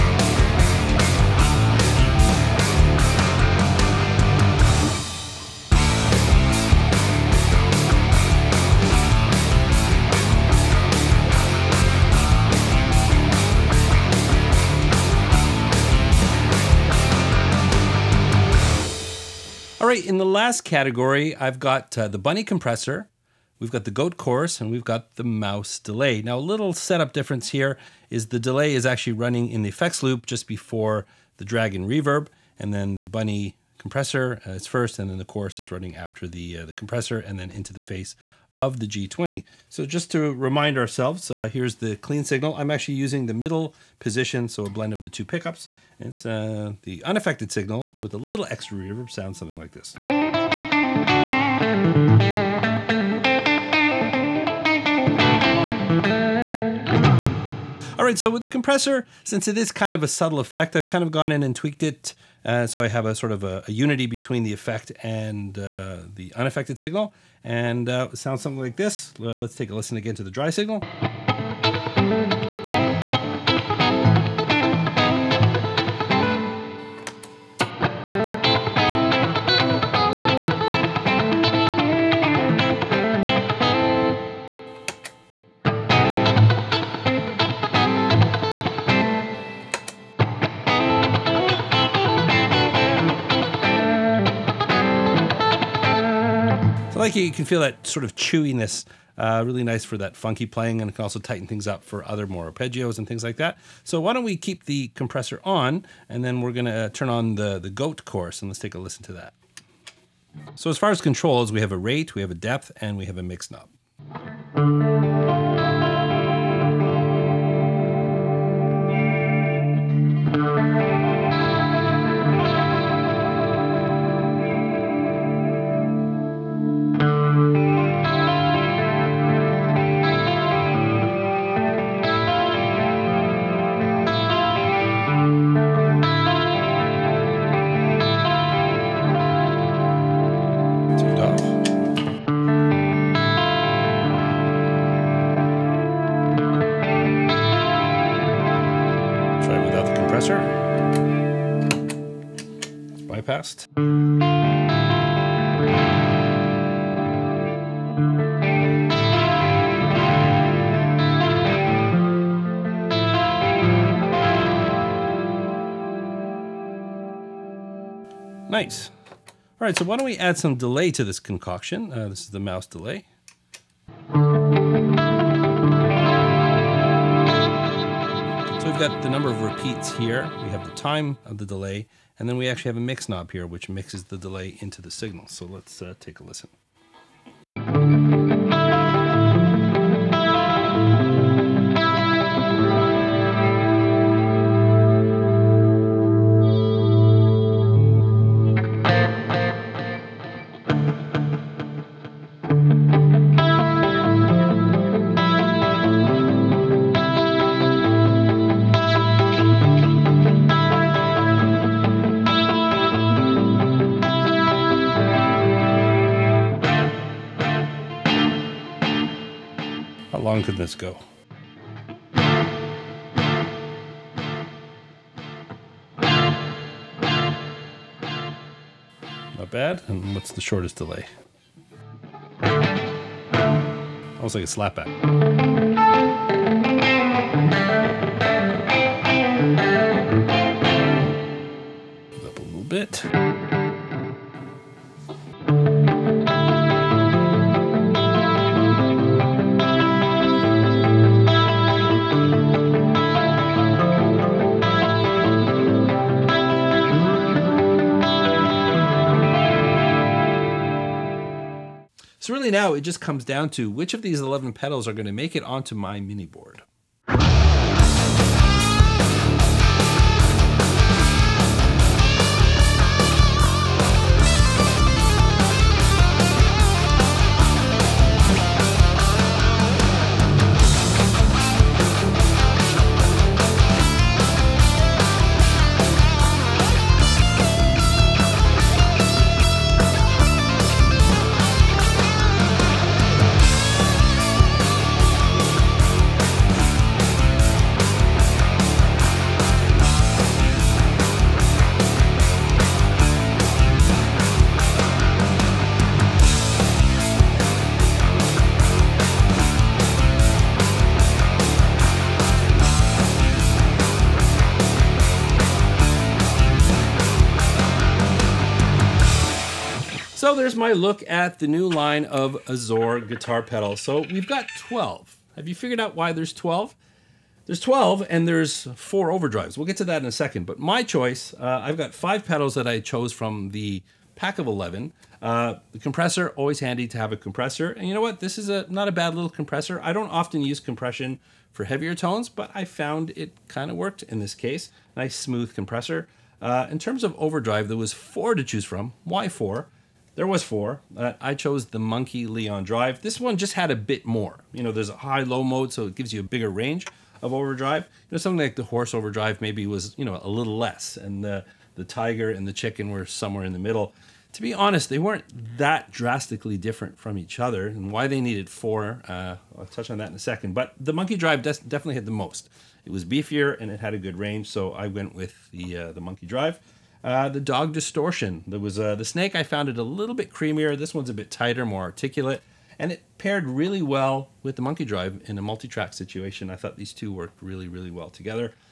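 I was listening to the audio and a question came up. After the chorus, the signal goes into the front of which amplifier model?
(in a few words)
G20.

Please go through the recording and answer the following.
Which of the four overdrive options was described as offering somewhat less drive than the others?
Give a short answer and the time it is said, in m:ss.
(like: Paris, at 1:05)
Horse Overdrive, at 5:58.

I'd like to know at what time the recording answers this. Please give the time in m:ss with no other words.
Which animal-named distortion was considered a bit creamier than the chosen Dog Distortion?
6:19.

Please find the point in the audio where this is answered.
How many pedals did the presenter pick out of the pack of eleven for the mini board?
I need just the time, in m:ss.
5:31.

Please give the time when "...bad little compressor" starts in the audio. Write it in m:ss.
5:38.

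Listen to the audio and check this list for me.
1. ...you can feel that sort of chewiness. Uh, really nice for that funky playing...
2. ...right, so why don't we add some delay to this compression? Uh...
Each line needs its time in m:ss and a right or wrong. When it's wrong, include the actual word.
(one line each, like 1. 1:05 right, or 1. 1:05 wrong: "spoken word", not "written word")
1. 1:37 right
2. 2:49 wrong: "concoction", not "compression".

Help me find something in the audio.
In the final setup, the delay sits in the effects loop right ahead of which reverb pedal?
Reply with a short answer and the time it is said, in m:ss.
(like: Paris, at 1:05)
Dragon reverb, at 0:31.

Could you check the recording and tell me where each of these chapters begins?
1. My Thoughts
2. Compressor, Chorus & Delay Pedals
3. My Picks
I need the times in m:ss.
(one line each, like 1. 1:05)
1. 5:19
2. 0:19
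3. 4:21.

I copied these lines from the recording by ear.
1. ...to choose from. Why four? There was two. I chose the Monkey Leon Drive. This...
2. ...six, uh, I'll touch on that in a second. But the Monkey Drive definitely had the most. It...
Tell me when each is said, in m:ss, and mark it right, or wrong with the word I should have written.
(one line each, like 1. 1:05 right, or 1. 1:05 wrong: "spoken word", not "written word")
1. 5:48 wrong: "four", not "two"
2. 6:08 wrong: "four", not "six".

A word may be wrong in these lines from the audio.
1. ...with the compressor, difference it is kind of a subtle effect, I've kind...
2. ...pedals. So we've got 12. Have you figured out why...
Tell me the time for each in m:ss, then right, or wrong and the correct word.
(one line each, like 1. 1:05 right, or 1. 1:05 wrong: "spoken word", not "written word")
1. 0:58 wrong: "since", not "difference"
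2. 5:23 right.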